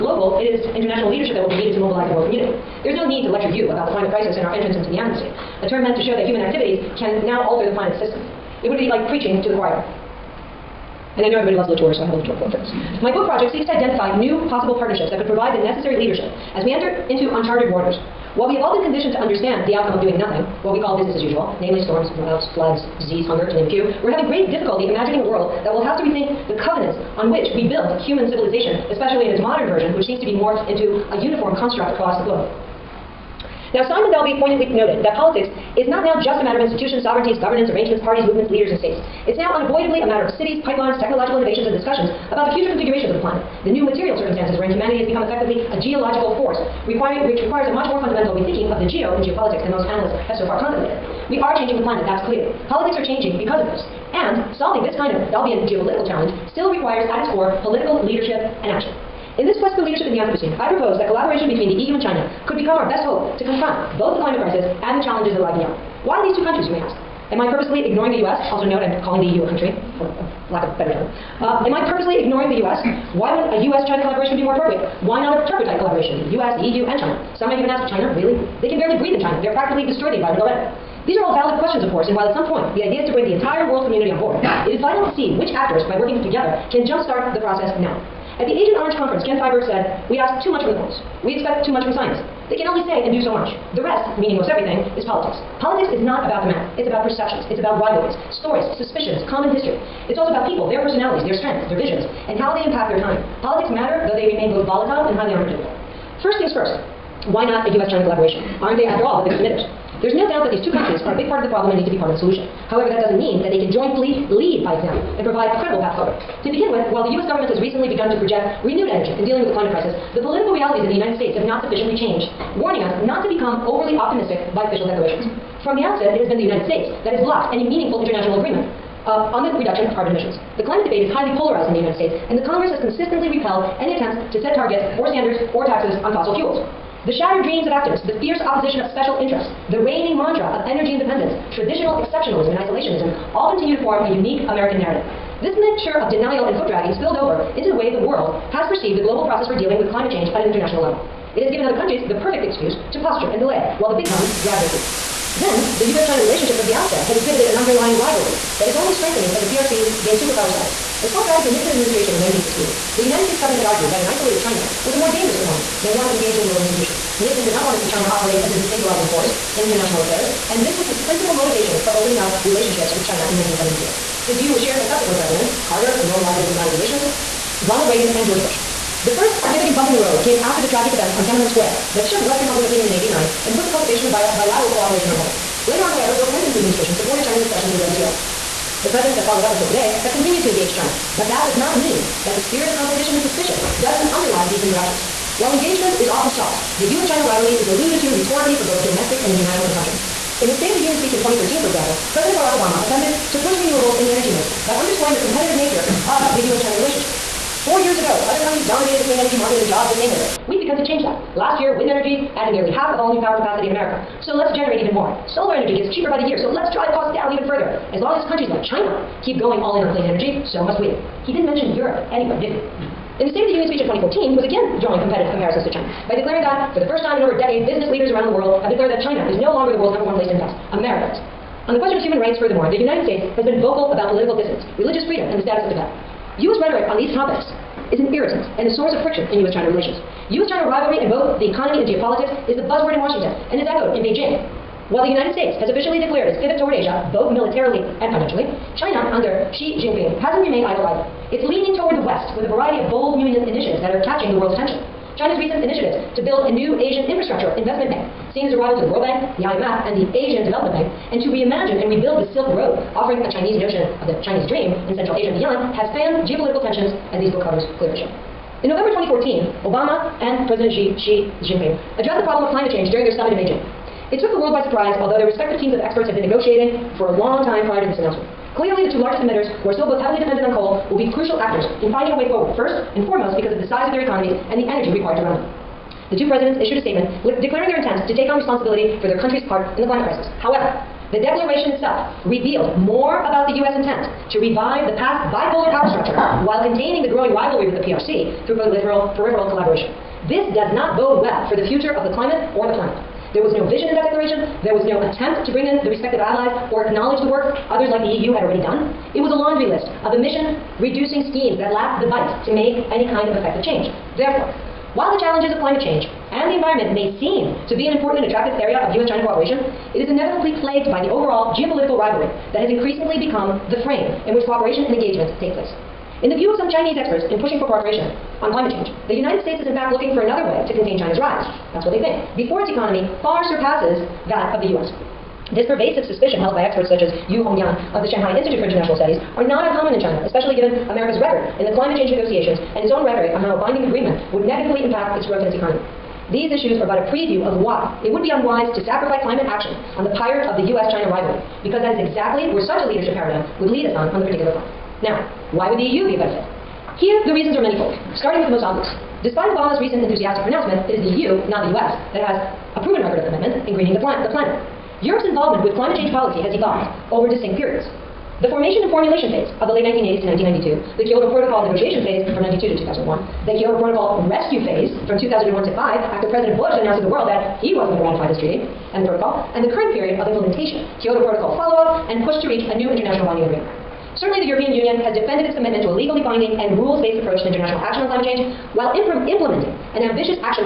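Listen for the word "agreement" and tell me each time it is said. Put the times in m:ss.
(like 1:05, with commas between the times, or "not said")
2:08, 5:43, 6:23.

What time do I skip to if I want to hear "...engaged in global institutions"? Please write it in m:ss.
2:46.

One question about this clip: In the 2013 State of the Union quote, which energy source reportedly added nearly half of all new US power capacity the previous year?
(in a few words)
Wind energy.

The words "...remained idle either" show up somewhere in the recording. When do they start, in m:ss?
4:10.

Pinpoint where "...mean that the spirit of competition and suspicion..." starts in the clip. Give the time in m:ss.
3:11.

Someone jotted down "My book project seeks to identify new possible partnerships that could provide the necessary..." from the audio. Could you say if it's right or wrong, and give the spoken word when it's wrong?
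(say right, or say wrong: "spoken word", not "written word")
right.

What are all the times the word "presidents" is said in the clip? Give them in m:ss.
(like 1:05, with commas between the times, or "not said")
2:55, 3:08, 3:22, 4:30, 4:46, 6:16.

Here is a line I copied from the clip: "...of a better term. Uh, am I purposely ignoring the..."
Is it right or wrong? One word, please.
right.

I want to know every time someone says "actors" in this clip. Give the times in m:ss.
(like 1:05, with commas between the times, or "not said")
1:25, 4:41.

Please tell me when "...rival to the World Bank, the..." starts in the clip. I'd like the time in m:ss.
4:18.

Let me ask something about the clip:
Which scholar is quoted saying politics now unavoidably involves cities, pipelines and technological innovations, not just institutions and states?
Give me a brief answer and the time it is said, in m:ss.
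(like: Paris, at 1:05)
Simon Dalby, at 0:33.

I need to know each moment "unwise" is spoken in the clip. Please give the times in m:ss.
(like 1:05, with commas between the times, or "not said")
5:48.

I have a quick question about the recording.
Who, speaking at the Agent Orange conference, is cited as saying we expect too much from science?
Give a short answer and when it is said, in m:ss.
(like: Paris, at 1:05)
Ken Feinberg, at 1:29.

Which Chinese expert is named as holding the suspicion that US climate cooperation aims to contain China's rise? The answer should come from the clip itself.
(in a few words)
Yu Hongyuan.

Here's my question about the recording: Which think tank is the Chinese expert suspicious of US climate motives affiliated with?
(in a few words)
Shanghai Institute for International Studies.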